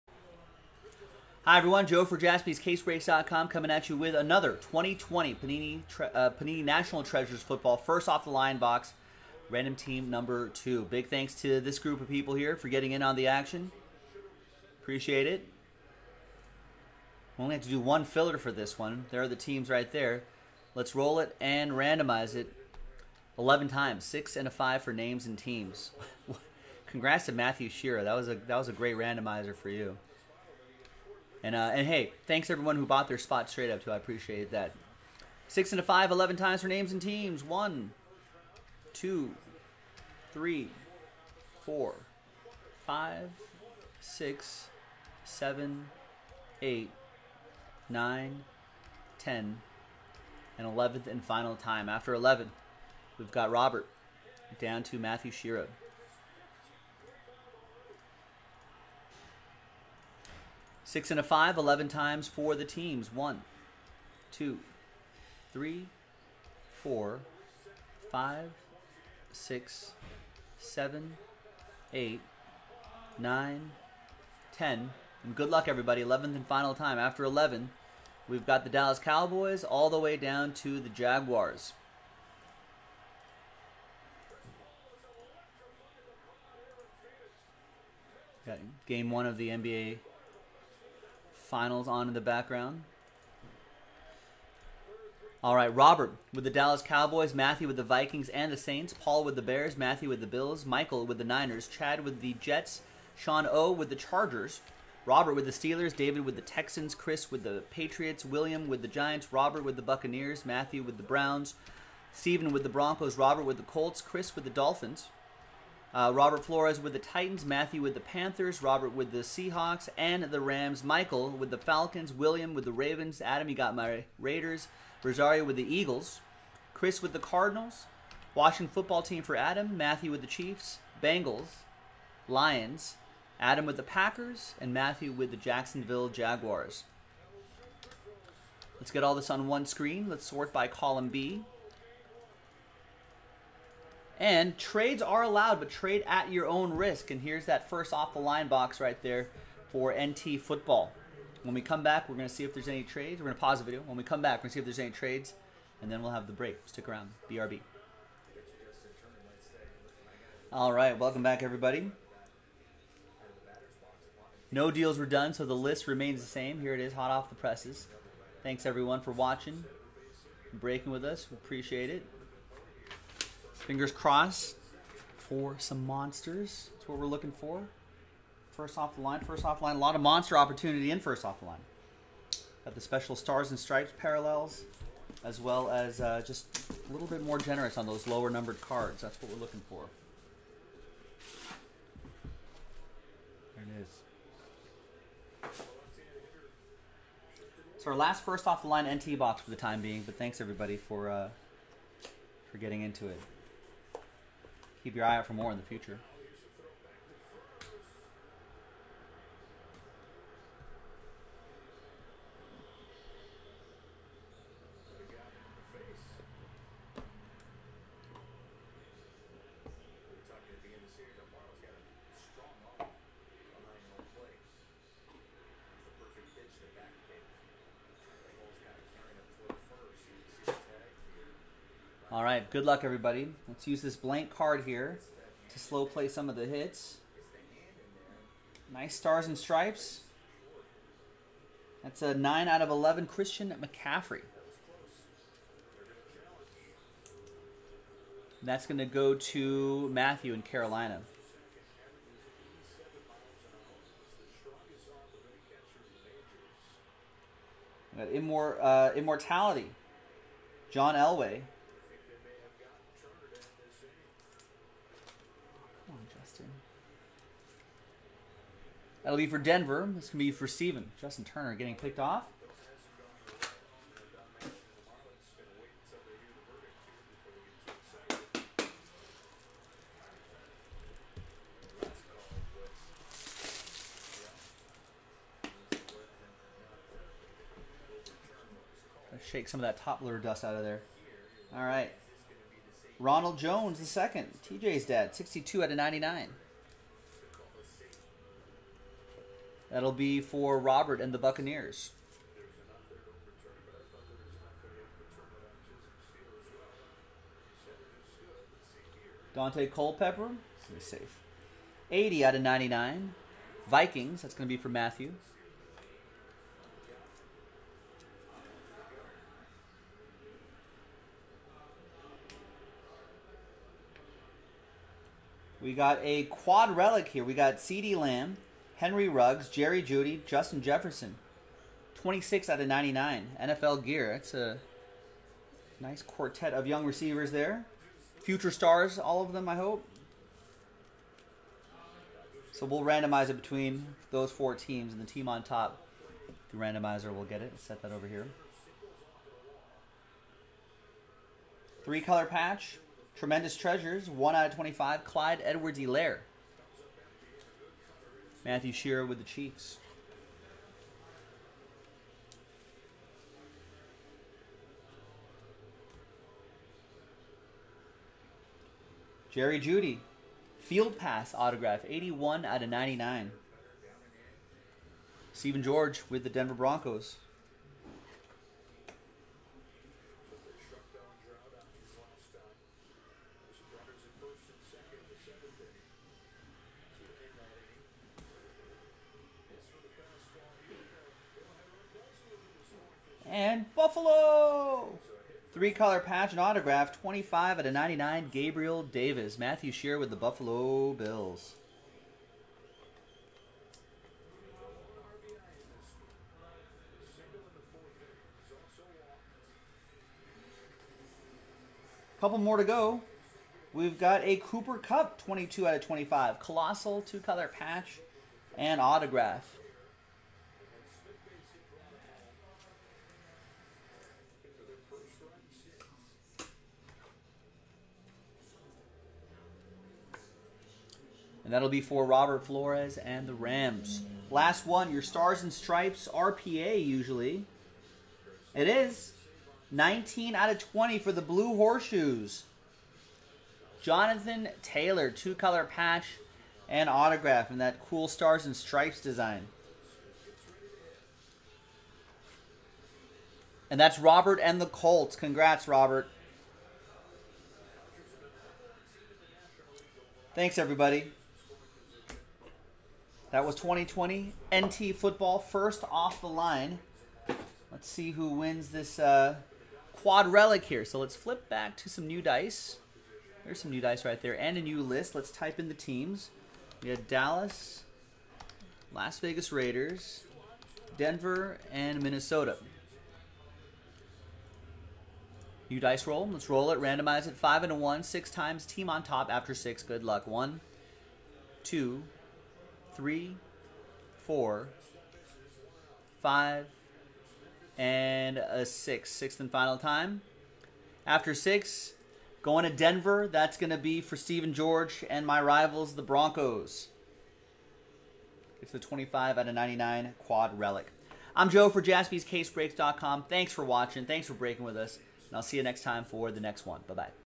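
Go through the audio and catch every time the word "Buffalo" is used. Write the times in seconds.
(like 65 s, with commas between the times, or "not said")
393 s, 400 s.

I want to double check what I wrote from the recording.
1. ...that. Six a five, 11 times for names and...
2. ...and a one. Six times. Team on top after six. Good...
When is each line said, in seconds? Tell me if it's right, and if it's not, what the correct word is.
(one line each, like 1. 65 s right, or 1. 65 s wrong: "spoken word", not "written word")
1. 34 s right
2. 487 s right.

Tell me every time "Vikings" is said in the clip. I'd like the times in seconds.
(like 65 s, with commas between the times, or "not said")
97 s, 313 s.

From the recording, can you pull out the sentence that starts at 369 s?
Jerry Jeudy, field pass autograph, 81 out of 99.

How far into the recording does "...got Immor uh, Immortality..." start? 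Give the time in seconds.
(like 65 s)
258 s.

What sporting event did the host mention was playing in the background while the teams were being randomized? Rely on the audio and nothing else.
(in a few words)
Game 1 of the NBA Finals.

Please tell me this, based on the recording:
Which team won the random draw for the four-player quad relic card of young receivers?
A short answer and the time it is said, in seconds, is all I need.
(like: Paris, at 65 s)
Denver Broncos, at 502 s.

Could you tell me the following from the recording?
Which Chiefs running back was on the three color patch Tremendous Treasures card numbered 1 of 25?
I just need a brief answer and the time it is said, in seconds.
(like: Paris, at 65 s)
Clyde Edwards-Helaire, at 355 s.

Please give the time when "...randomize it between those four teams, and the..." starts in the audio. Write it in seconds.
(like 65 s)
342 s.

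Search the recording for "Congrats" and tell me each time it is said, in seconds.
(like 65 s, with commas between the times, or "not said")
26 s, 455 s.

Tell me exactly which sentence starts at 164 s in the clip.
No deals were done, so the list remains the same.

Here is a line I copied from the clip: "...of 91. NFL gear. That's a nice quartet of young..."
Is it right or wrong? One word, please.
wrong.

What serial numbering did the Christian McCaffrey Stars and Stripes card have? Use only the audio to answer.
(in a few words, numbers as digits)
9 out of 11.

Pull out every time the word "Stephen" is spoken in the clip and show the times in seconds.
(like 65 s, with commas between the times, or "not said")
112 s, 375 s.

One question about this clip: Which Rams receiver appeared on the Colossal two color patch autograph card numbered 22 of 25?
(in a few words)
Cooper Kupp.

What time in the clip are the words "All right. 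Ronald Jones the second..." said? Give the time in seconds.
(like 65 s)
291 s.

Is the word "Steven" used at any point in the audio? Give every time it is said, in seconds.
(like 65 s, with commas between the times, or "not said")
270 s, 504 s.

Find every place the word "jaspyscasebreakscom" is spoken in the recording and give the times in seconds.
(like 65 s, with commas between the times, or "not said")
2 s, 511 s.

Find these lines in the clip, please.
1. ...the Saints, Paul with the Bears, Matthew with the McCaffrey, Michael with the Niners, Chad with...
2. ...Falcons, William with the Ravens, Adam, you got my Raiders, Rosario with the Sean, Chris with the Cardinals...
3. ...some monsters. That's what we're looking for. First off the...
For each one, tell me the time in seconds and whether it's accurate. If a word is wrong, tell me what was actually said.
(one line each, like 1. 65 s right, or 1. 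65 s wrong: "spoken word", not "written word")
1. 98 s wrong: "Bills", not "McCaffrey"
2. 121 s wrong: "Eagles", not "Sean"
3. 175 s right.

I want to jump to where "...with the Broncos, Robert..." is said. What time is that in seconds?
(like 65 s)
112 s.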